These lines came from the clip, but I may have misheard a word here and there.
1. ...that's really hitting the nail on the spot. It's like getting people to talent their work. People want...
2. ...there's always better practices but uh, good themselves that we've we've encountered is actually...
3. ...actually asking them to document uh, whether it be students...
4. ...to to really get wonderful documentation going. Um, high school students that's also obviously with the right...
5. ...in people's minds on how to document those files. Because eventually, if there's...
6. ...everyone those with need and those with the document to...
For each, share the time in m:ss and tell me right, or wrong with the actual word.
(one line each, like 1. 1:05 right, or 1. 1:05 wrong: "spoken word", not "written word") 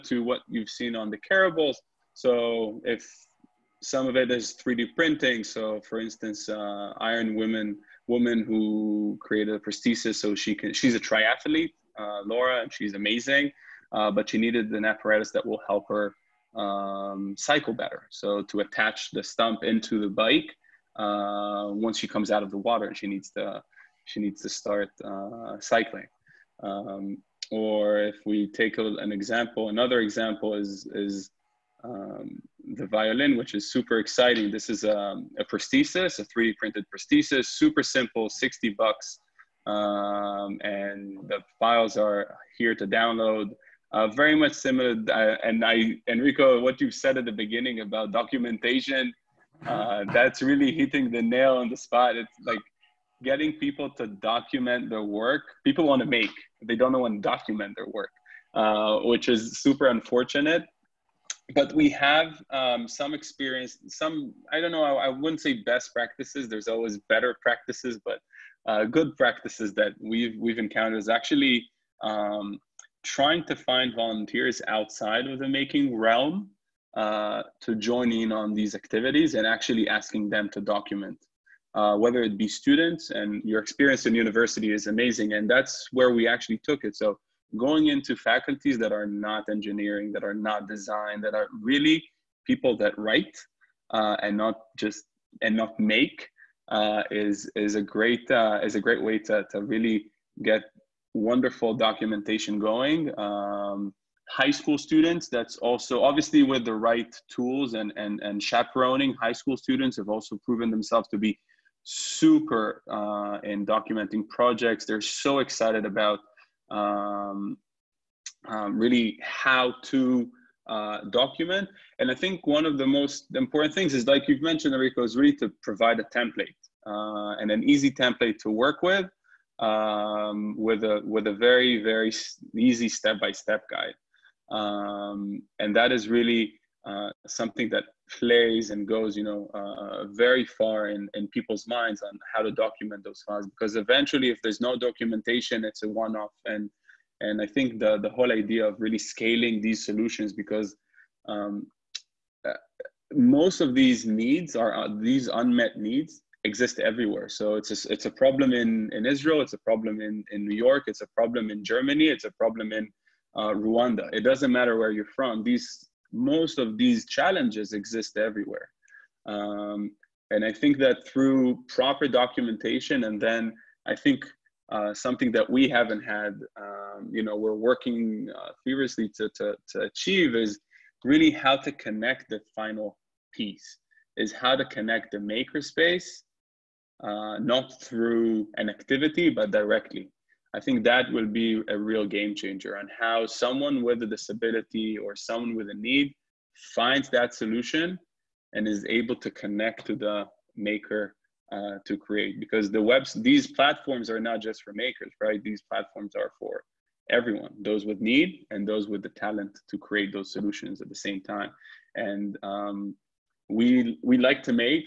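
1. 0:50 wrong: "document", not "talent"
2. 1:06 wrong: "practices", not "themselves"
3. 1:19 right
4. 1:39 right
5. 2:21 right
6. 3:27 wrong: "talent", not "document".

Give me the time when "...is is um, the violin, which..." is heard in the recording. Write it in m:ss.
0:30.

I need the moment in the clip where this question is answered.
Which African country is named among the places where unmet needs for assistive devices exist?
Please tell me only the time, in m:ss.
2:43.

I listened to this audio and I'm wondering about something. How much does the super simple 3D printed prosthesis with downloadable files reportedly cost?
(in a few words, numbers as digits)
$60.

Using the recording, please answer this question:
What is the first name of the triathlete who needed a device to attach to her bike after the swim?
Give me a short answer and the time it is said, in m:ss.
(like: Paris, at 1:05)
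Laura, at 0:12.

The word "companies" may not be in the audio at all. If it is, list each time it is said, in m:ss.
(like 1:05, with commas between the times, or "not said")
not said.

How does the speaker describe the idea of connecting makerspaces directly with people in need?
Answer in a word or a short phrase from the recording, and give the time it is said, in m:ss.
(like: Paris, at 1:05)
a real game changer, at 3:11.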